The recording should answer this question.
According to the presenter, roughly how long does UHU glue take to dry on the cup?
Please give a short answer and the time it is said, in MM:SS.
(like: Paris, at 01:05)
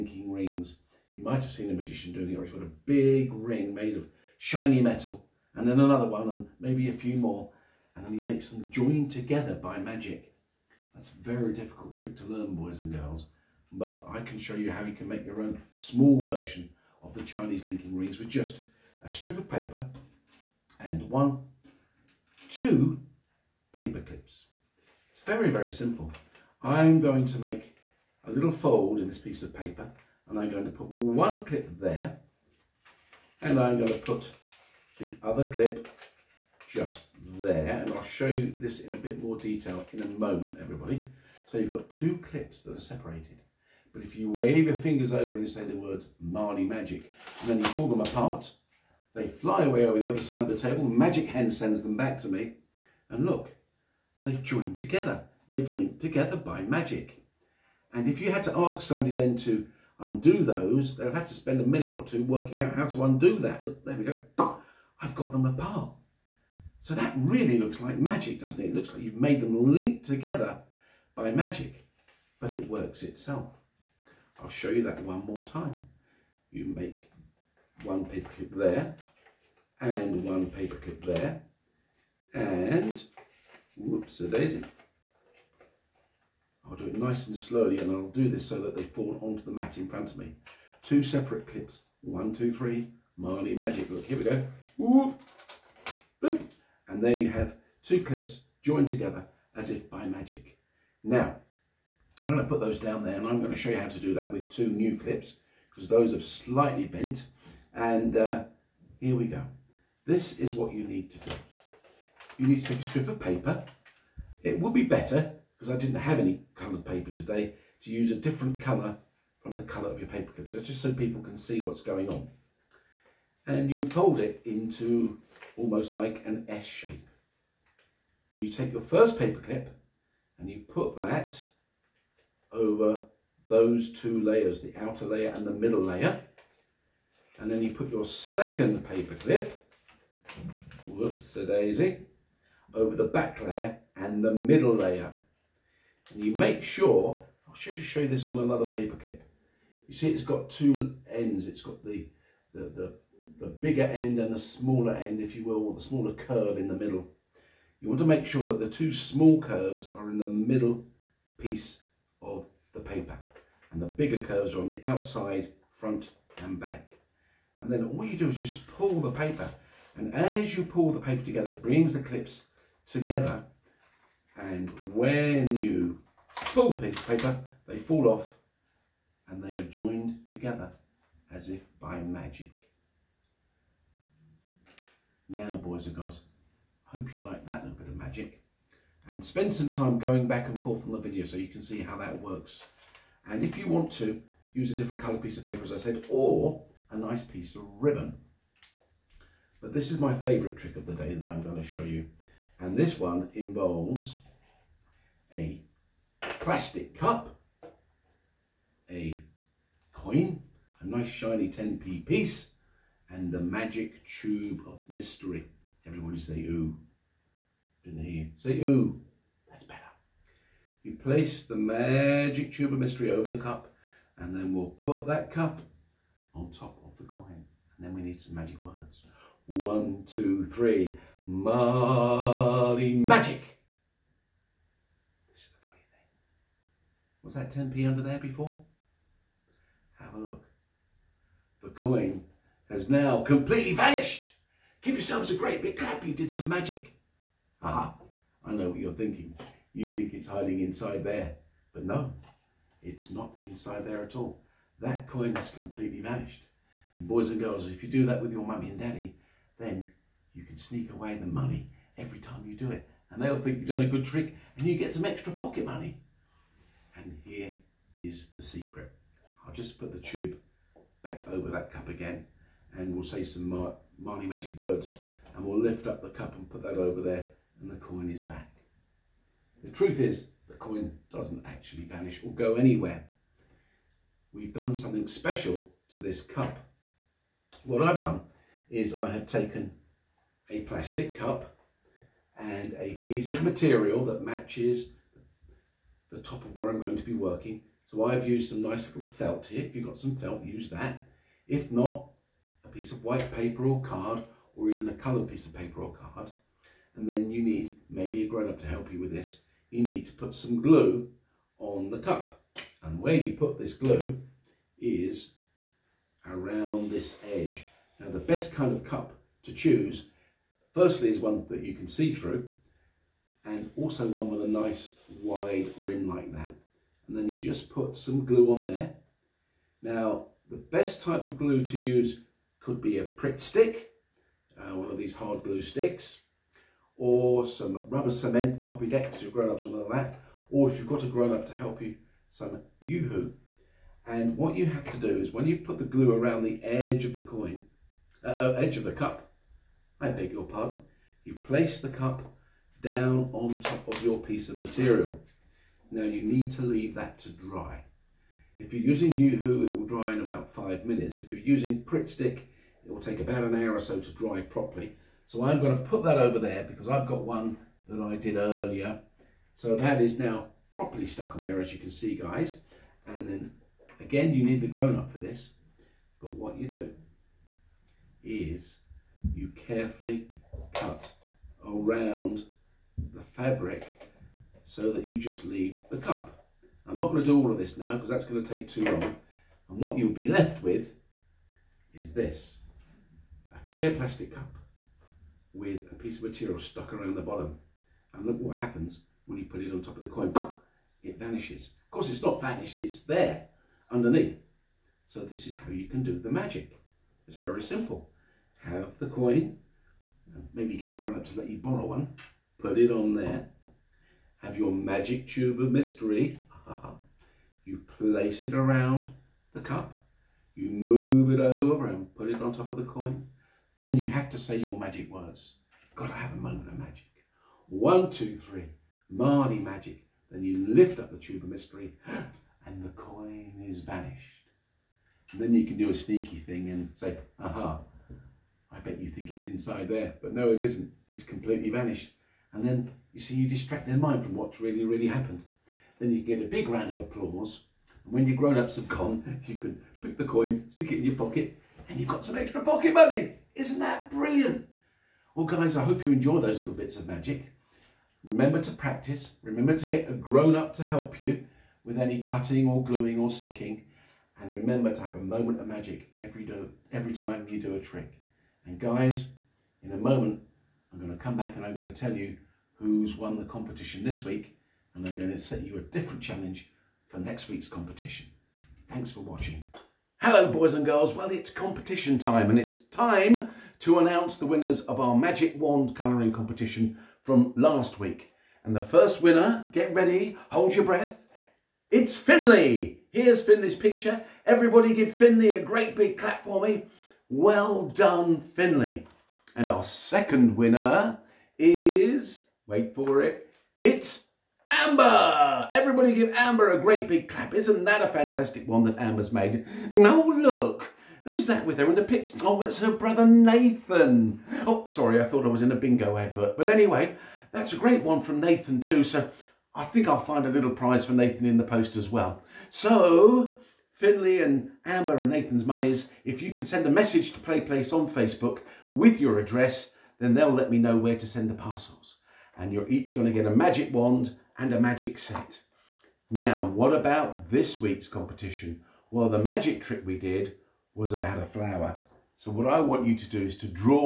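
about 5 minutes, at 06:00.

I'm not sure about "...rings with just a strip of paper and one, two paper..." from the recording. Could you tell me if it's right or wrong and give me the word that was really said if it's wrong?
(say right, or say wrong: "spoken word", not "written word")
right.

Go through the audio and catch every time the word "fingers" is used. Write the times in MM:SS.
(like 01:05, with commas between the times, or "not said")
00:44.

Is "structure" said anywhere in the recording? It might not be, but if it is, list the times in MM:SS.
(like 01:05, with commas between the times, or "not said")
not said.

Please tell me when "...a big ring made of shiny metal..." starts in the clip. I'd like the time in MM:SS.
00:02.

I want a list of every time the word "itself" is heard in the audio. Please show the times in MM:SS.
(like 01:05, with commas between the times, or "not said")
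01:13.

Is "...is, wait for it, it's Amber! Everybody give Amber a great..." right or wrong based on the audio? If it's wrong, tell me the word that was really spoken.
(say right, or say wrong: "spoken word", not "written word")
right.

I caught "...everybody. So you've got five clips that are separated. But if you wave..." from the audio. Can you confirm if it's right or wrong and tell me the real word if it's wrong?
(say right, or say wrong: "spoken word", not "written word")
wrong: "two", not "five".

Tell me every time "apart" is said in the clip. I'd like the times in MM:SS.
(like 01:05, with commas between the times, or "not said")
00:48, 01:05.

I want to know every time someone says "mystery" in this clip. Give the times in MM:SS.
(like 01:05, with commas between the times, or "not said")
03:34, 03:42, 06:55, 07:11.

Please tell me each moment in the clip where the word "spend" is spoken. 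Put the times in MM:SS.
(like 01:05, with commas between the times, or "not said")
01:01, 03:09.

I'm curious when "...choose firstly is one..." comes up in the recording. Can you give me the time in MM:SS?
05:19.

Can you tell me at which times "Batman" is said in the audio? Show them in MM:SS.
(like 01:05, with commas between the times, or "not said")
not said.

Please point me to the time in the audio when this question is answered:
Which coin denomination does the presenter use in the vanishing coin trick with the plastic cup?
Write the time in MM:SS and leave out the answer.
03:31.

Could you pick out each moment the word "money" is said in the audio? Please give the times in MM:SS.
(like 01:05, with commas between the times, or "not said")
04:21, 04:25, 07:32.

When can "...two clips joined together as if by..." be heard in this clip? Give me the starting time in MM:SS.
01:37.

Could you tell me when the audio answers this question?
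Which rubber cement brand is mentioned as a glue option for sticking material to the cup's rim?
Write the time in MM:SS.
05:38.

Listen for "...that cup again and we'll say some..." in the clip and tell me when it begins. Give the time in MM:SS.
04:31.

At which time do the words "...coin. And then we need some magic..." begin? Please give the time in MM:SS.
03:47.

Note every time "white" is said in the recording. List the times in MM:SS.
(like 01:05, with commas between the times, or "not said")
05:03.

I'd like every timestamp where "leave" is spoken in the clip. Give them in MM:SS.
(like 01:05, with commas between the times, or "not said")
05:56, 06:25.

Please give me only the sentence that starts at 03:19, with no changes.
But this is my favourite trick of the day that I'm going to show you.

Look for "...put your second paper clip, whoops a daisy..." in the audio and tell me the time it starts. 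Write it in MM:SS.
02:17.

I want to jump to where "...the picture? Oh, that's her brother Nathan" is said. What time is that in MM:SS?
08:31.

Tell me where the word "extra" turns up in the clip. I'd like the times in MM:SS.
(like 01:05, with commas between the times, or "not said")
04:25, 07:32.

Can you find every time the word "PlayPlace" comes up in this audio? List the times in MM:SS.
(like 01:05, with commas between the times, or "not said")
08:47.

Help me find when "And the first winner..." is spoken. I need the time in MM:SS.
08:08.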